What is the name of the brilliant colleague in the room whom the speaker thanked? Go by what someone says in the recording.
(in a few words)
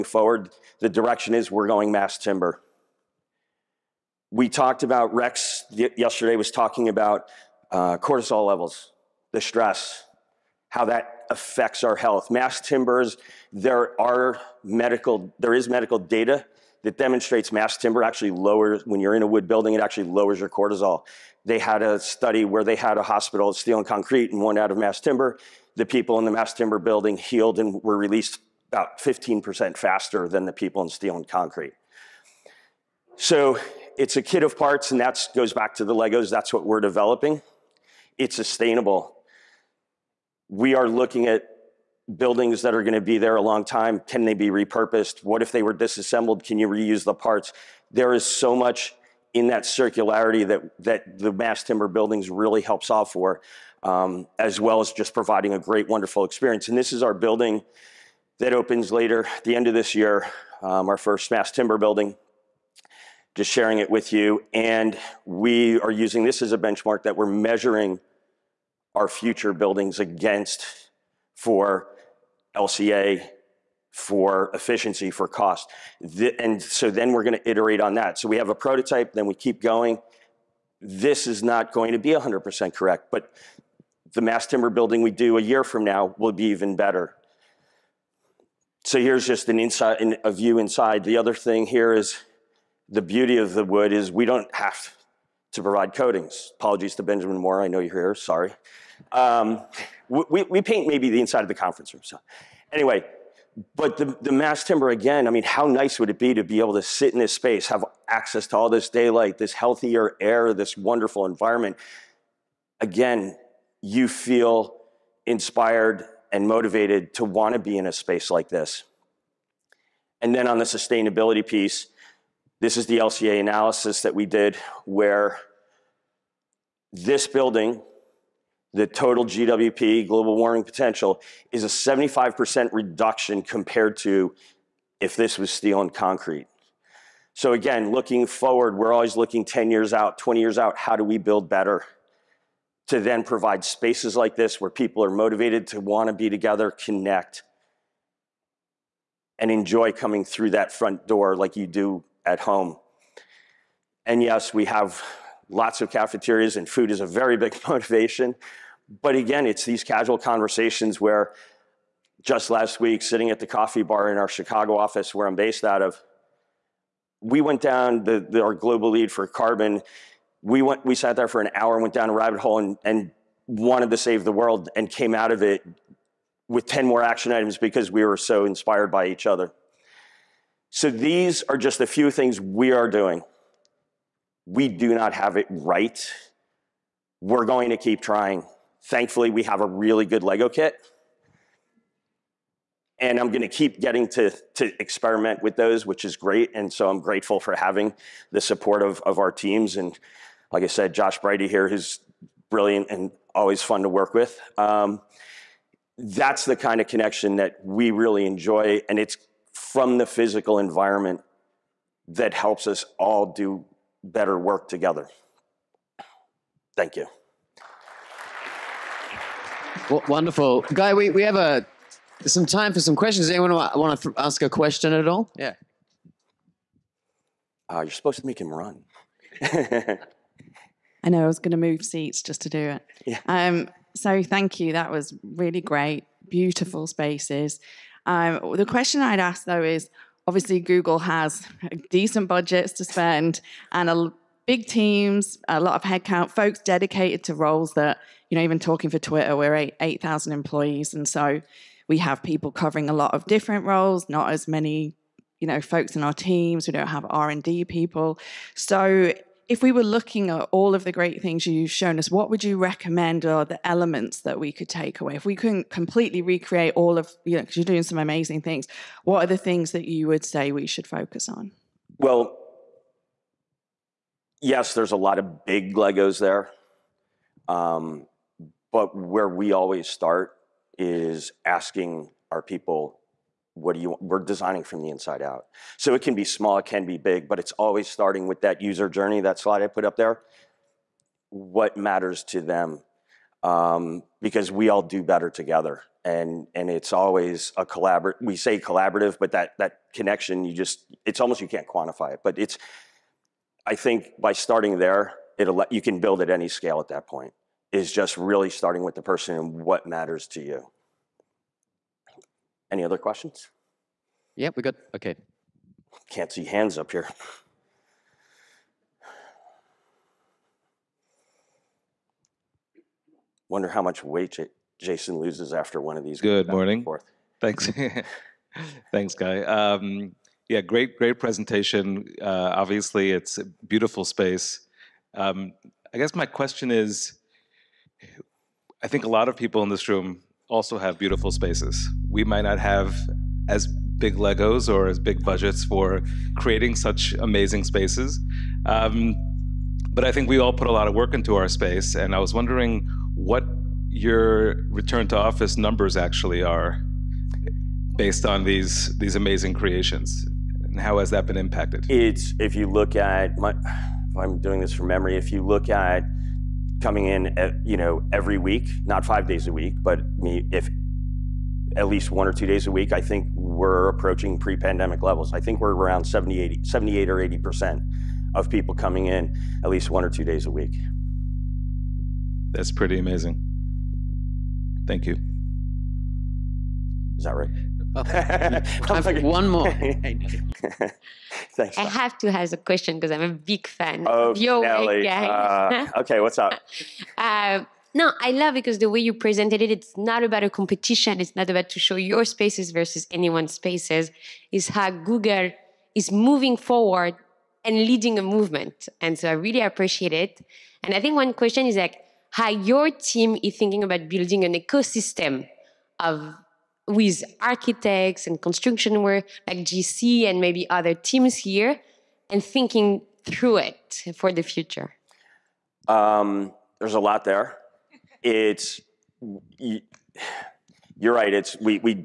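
Josh Brady.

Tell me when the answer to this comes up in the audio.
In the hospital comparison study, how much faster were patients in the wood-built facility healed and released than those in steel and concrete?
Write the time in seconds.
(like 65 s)
28 s.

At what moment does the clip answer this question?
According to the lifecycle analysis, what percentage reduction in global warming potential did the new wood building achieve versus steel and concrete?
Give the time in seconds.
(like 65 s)
131 s.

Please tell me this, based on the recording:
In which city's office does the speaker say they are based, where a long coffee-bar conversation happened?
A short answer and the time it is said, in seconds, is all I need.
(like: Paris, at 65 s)
Chicago, at 164 s.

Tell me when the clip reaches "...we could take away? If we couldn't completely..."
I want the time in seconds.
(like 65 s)
264 s.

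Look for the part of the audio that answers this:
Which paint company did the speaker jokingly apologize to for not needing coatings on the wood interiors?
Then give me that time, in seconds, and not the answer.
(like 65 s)
97 s.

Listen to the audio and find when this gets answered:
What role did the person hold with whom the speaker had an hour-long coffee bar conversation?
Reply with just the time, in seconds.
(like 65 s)
168 s.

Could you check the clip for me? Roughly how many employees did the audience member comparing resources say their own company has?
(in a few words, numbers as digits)
8,000.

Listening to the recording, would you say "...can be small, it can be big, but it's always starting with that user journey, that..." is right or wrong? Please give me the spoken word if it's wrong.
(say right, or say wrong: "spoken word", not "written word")
right.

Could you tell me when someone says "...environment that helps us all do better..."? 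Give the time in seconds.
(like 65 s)
210 s.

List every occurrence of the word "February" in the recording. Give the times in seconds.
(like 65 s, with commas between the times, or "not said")
not said.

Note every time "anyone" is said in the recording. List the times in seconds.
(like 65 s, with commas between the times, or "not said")
223 s, 403 s.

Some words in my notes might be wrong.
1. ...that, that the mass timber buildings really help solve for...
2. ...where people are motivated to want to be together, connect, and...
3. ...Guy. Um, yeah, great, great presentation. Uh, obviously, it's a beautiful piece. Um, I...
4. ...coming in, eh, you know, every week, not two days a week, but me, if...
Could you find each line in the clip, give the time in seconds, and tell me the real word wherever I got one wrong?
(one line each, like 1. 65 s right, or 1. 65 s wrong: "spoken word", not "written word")
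1. 50 s right
2. 144 s right
3. 329 s wrong: "space", not "piece"
4. 366 s wrong: "five", not "two".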